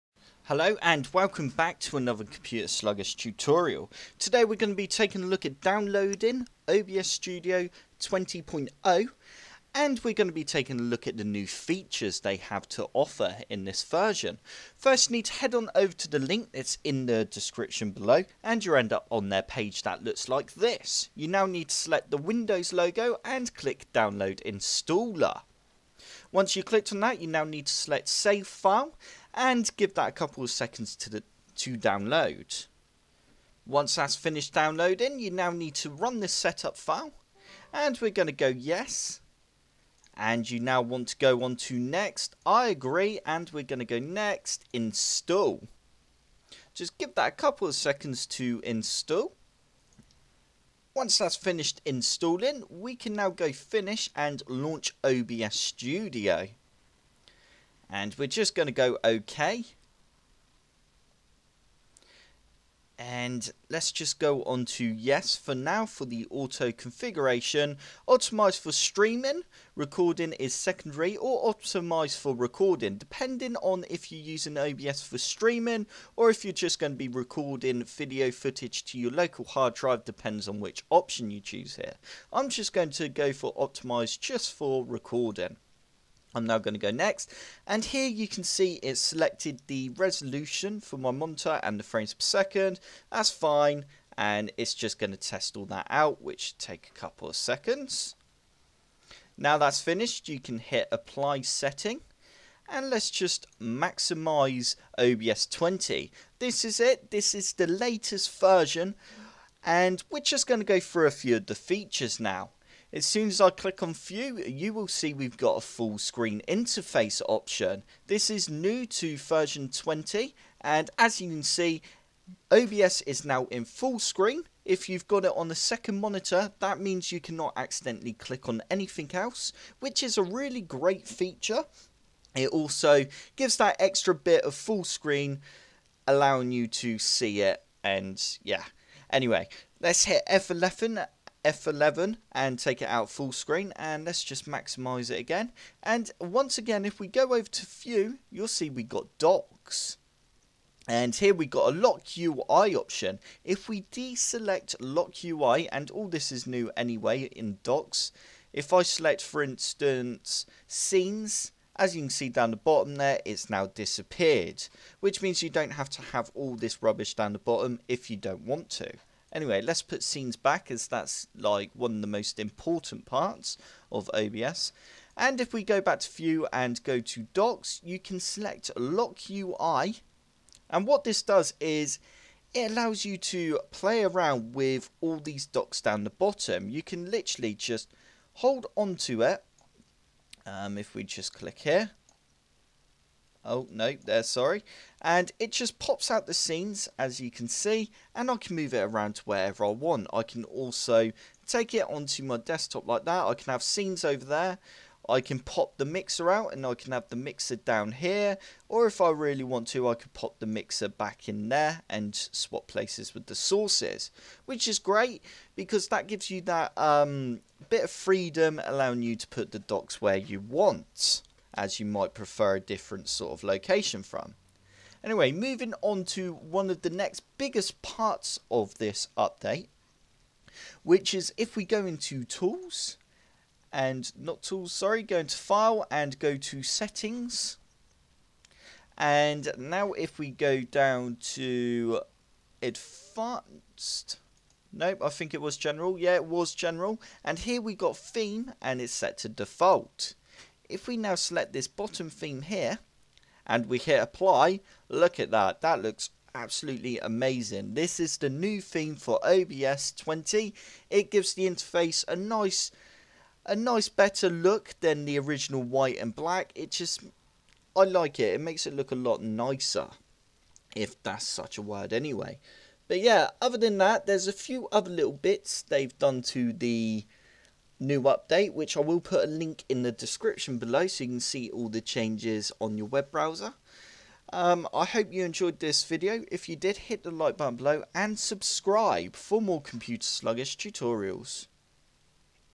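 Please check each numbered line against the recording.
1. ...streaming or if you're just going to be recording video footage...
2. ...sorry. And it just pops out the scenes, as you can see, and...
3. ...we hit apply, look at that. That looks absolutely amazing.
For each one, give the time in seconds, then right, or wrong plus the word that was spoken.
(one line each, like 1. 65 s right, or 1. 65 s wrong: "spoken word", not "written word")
1. 75 s right
2. 194 s right
3. 253 s right.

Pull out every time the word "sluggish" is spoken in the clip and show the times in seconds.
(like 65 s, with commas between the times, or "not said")
2 s, 290 s.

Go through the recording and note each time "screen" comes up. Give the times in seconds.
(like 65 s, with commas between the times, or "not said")
115 s, 123 s, 134 s, 143 s.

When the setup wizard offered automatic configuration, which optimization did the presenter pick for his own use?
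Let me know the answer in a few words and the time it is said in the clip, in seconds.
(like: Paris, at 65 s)
Optimized just for recording, at 83 s.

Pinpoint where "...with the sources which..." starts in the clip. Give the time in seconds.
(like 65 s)
213 s.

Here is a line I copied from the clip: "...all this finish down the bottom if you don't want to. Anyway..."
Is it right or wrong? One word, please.
wrong.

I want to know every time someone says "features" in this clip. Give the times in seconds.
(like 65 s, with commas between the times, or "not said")
11 s, 111 s, 131 s.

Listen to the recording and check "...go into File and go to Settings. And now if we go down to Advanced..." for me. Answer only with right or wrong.
right.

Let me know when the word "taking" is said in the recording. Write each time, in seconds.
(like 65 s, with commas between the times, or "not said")
4 s, 10 s.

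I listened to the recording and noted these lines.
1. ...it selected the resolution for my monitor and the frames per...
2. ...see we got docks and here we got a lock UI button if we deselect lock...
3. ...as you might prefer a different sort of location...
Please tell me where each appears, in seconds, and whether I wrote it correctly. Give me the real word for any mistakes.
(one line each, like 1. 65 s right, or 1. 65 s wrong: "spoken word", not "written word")
1. 88 s right
2. 148 s wrong: "option", not "button"
3. 221 s right.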